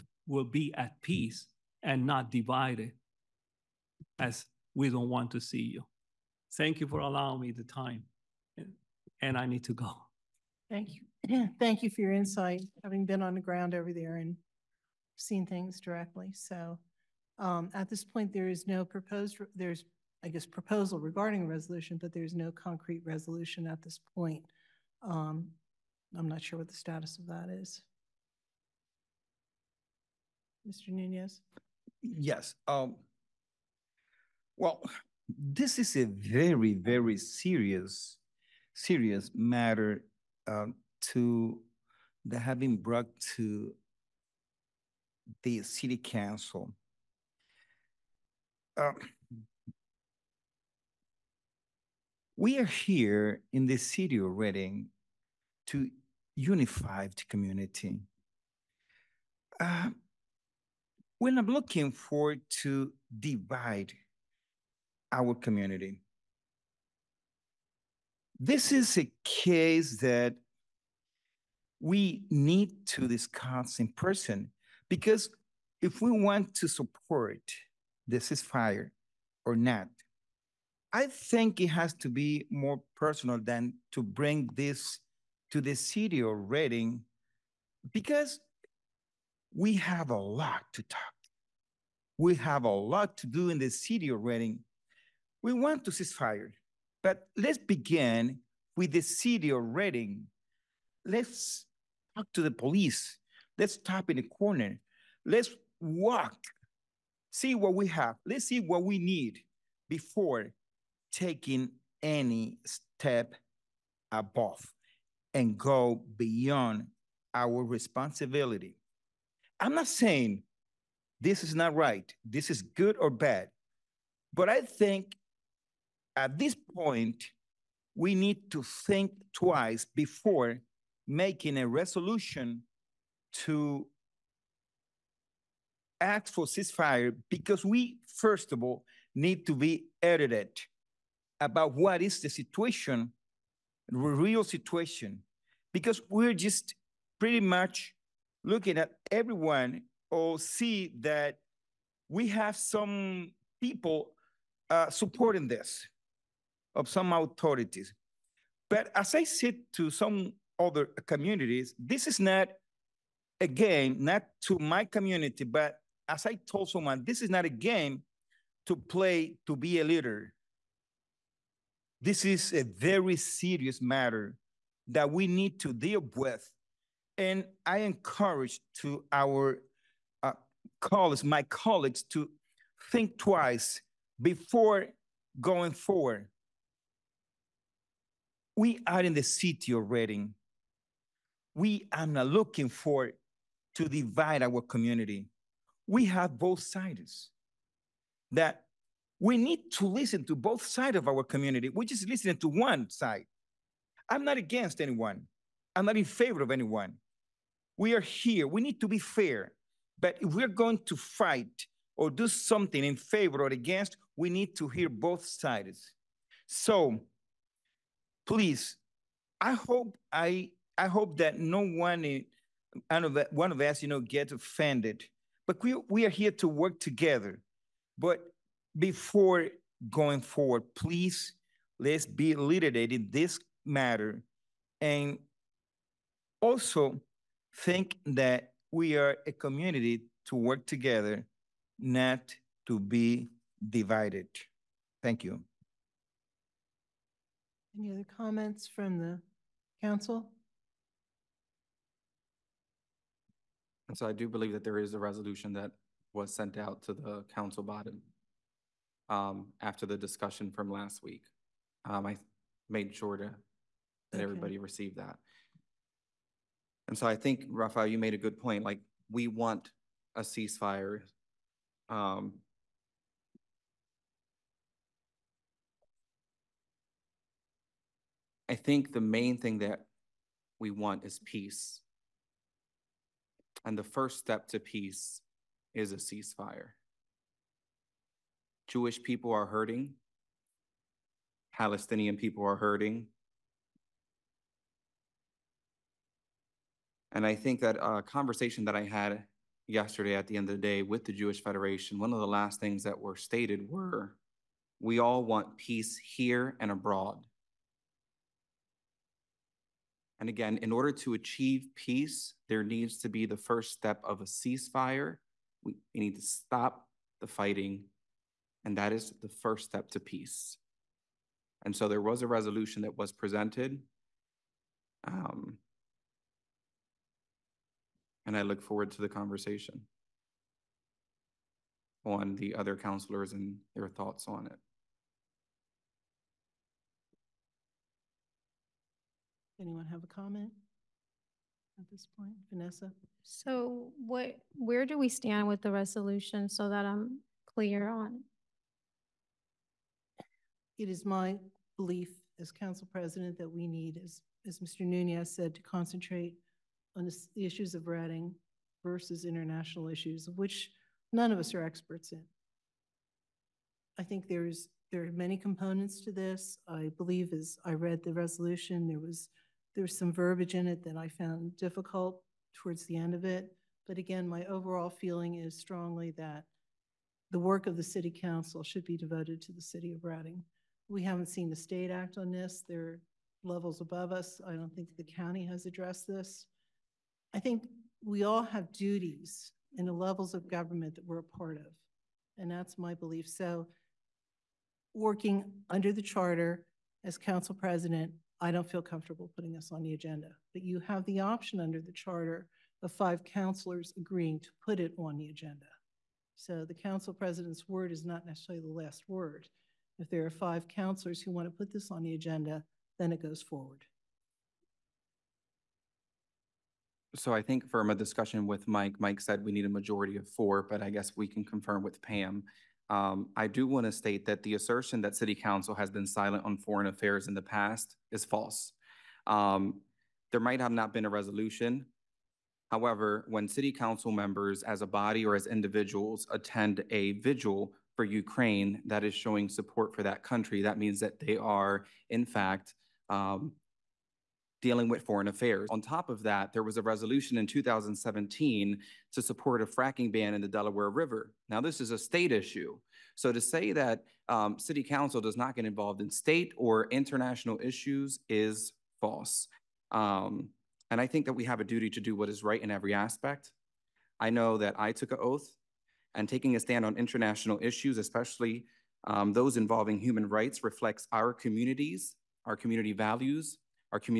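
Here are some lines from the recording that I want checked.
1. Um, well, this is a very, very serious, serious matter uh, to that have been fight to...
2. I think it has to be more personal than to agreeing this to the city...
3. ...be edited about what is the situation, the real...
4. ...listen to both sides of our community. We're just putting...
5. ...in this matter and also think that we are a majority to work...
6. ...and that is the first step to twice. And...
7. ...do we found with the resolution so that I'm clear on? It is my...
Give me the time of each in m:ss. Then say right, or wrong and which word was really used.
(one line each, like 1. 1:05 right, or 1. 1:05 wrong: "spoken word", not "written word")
1. 0:32 wrong: "brought", not "fight"
2. 1:20 wrong: "bring", not "agreeing"
3. 2:19 right
4. 3:19 wrong: "listening", not "putting"
5. 3:52 wrong: "community", not "majority"
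6. 5:18 wrong: "peace", not "twice"
7. 5:44 wrong: "stand", not "found".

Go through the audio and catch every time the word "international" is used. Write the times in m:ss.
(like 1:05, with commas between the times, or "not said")
5:59, 7:36, 7:46.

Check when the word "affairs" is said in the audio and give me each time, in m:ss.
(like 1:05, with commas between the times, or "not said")
7:06, 7:25.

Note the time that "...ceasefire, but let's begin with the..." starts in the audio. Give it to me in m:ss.
1:35.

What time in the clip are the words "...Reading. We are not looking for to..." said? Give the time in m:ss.
3:09.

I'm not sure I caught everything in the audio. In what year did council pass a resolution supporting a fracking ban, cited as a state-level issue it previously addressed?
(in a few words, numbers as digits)
2017.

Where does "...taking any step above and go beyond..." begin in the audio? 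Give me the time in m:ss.
1:51.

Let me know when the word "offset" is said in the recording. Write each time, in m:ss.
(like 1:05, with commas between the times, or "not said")
not said.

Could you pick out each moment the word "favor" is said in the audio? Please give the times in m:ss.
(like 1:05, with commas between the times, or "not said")
3:26, 3:32.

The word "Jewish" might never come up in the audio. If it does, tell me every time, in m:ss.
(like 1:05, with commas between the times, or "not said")
4:48, 5:01.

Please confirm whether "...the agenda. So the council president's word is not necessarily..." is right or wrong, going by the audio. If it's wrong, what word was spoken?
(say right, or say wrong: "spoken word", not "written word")
right.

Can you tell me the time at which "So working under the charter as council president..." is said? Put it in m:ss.
6:33.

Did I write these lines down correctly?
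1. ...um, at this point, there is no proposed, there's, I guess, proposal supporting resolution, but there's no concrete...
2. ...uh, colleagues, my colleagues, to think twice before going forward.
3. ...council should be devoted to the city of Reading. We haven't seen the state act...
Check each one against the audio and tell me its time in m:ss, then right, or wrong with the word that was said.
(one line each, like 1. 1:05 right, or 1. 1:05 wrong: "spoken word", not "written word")
1. 0:17 wrong: "regarding", not "supporting"
2. 3:00 right
3. 6:18 right.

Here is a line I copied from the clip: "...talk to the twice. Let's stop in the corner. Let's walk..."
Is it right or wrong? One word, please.
wrong.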